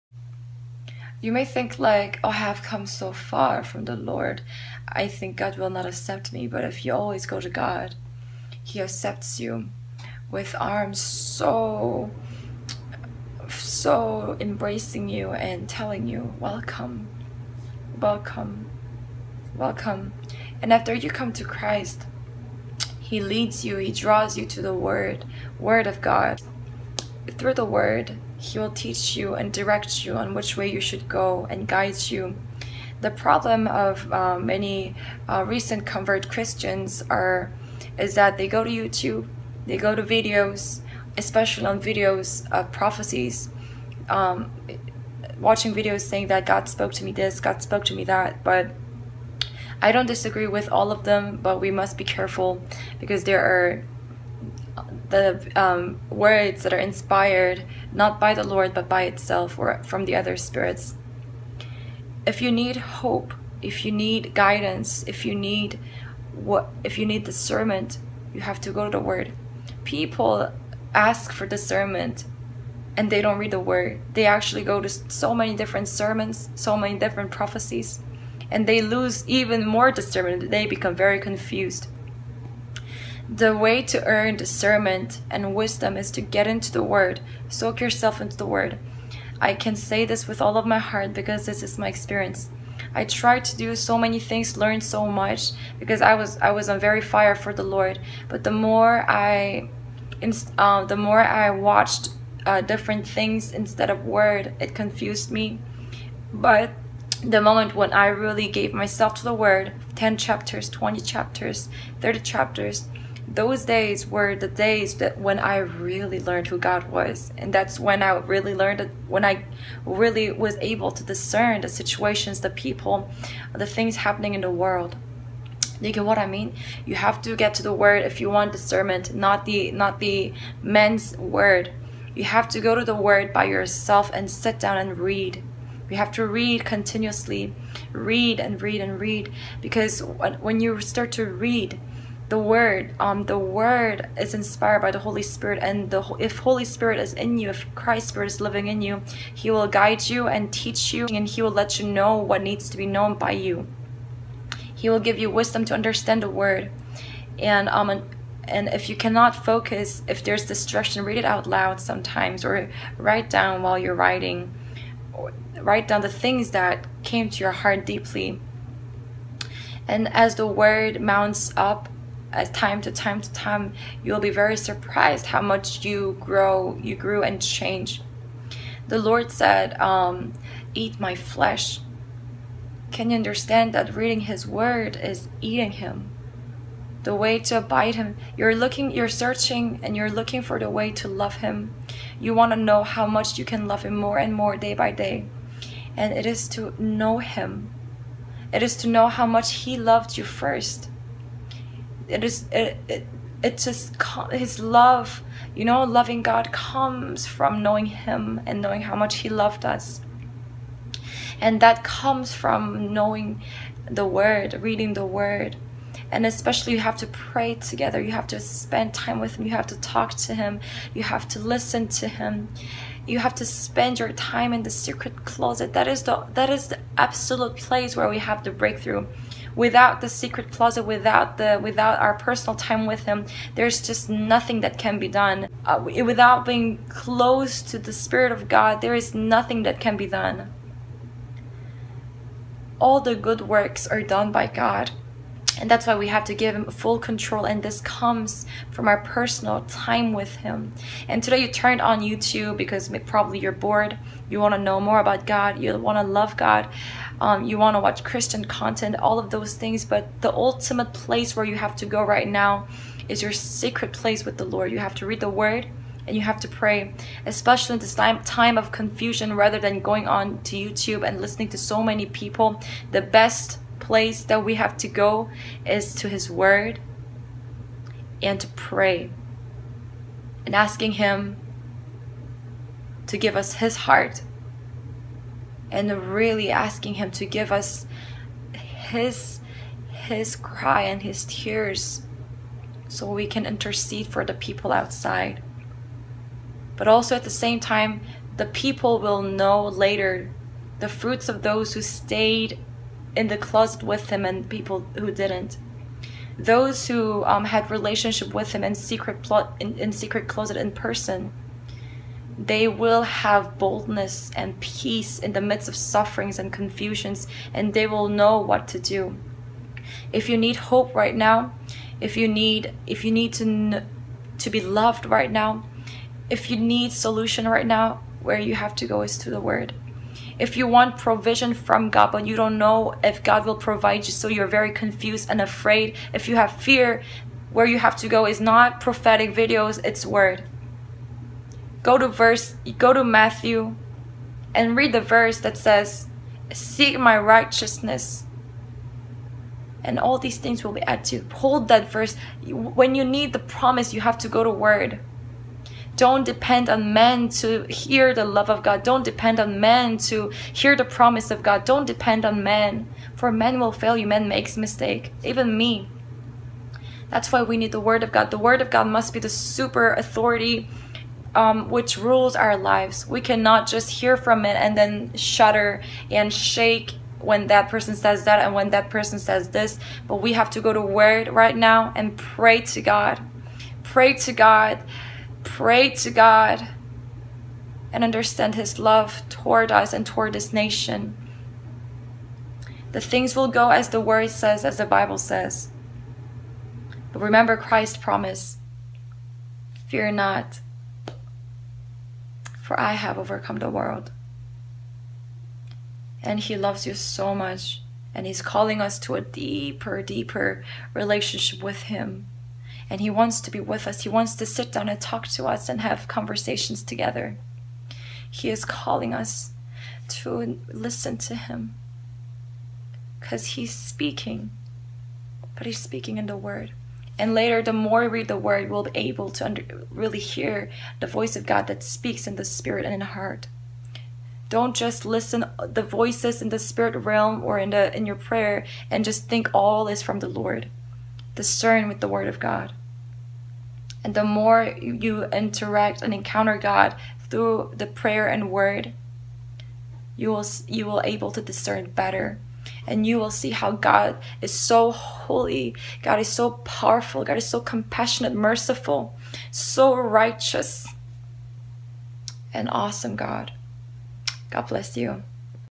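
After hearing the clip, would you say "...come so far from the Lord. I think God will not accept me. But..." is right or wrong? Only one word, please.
right.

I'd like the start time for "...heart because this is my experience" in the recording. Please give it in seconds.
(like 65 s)
90 s.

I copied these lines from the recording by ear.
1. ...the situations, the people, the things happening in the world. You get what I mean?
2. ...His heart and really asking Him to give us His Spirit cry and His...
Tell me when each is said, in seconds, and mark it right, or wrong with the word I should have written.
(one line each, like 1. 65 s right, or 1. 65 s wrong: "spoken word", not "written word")
1. 121 s right
2. 283 s wrong: "His", not "Spirit".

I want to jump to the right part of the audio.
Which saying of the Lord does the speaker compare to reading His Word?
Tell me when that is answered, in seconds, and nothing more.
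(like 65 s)
180 s.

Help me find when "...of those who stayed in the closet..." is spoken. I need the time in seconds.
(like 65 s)
301 s.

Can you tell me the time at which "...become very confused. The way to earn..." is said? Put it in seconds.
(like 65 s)
80 s.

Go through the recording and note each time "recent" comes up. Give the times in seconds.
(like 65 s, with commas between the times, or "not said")
35 s.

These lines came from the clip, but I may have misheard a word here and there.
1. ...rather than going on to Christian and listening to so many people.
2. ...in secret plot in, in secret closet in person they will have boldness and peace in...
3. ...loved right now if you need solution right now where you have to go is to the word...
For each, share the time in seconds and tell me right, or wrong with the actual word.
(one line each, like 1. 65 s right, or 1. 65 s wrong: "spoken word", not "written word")
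1. 269 s wrong: "YouTube", not "Christian"
2. 308 s right
3. 324 s right.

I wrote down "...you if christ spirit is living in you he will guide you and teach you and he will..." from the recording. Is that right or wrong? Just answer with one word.
right.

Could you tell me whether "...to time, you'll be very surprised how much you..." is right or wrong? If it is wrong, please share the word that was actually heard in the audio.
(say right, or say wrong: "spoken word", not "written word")
right.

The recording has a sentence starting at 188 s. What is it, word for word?
You're looking, you're searching, and you're looking for the way to love Him.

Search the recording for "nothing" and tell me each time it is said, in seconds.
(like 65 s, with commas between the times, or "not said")
234 s, 239 s.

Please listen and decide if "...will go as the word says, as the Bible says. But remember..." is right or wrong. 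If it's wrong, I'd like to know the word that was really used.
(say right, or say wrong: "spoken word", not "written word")
right.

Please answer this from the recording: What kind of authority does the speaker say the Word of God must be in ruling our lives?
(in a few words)
Super authority.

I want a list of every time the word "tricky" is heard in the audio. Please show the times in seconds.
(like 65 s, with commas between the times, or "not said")
not said.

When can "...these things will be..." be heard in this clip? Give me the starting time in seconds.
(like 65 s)
350 s.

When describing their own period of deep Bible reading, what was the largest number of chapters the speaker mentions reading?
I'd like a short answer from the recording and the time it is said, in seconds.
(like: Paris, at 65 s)
30 chapters, at 112 s.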